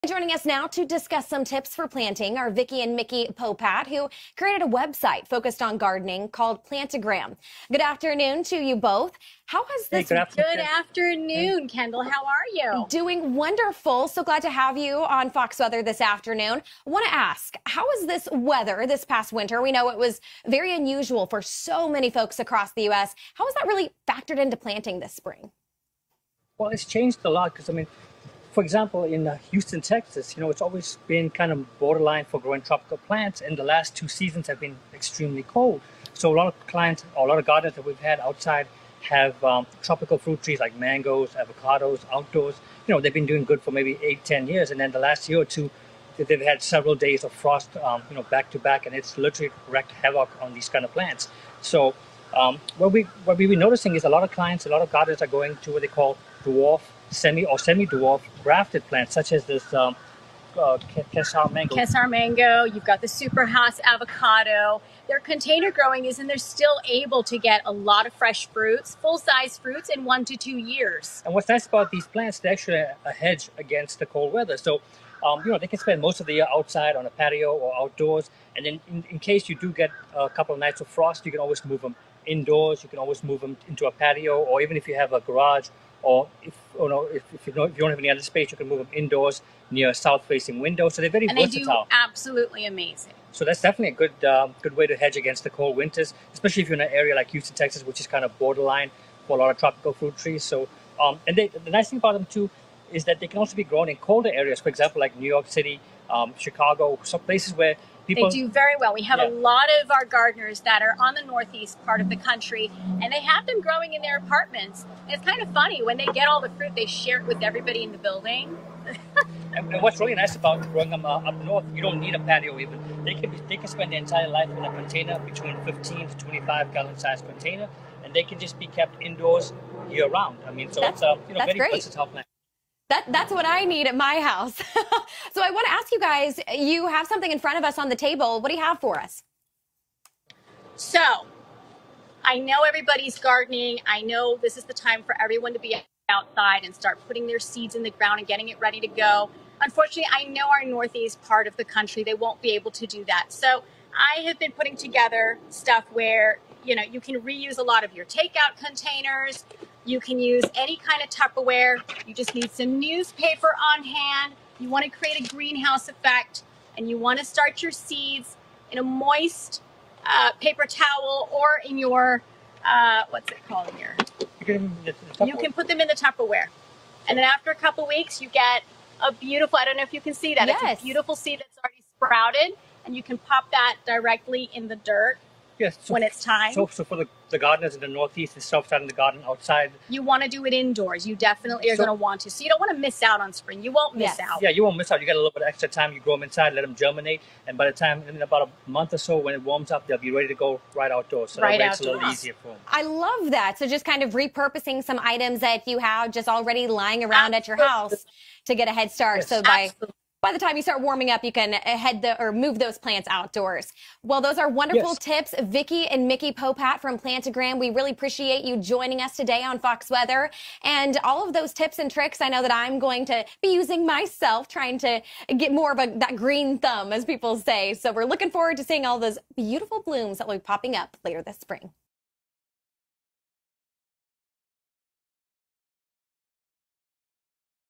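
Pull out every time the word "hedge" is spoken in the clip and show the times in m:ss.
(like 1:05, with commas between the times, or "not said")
1:13, 1:34.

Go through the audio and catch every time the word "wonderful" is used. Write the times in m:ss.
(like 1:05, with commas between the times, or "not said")
0:13, 3:34.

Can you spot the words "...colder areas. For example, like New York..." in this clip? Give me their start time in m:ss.
1:43.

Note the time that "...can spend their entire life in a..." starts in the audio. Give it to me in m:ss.
2:03.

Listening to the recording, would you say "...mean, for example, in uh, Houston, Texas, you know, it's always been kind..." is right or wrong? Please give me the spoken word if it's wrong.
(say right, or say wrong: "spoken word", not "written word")
right.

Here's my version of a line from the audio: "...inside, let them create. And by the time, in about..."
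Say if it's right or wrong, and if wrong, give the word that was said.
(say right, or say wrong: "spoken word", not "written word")
wrong: "germinate", not "create".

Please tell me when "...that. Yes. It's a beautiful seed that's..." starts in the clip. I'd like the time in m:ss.
3:00.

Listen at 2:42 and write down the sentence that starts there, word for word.
You just need some newspaper on hand.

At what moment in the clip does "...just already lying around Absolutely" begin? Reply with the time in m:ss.
3:26.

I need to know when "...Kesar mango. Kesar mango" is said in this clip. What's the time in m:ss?
1:01.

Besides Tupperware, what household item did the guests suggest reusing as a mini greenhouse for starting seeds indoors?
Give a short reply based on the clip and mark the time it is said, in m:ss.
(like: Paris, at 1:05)
Takeout containers, at 2:38.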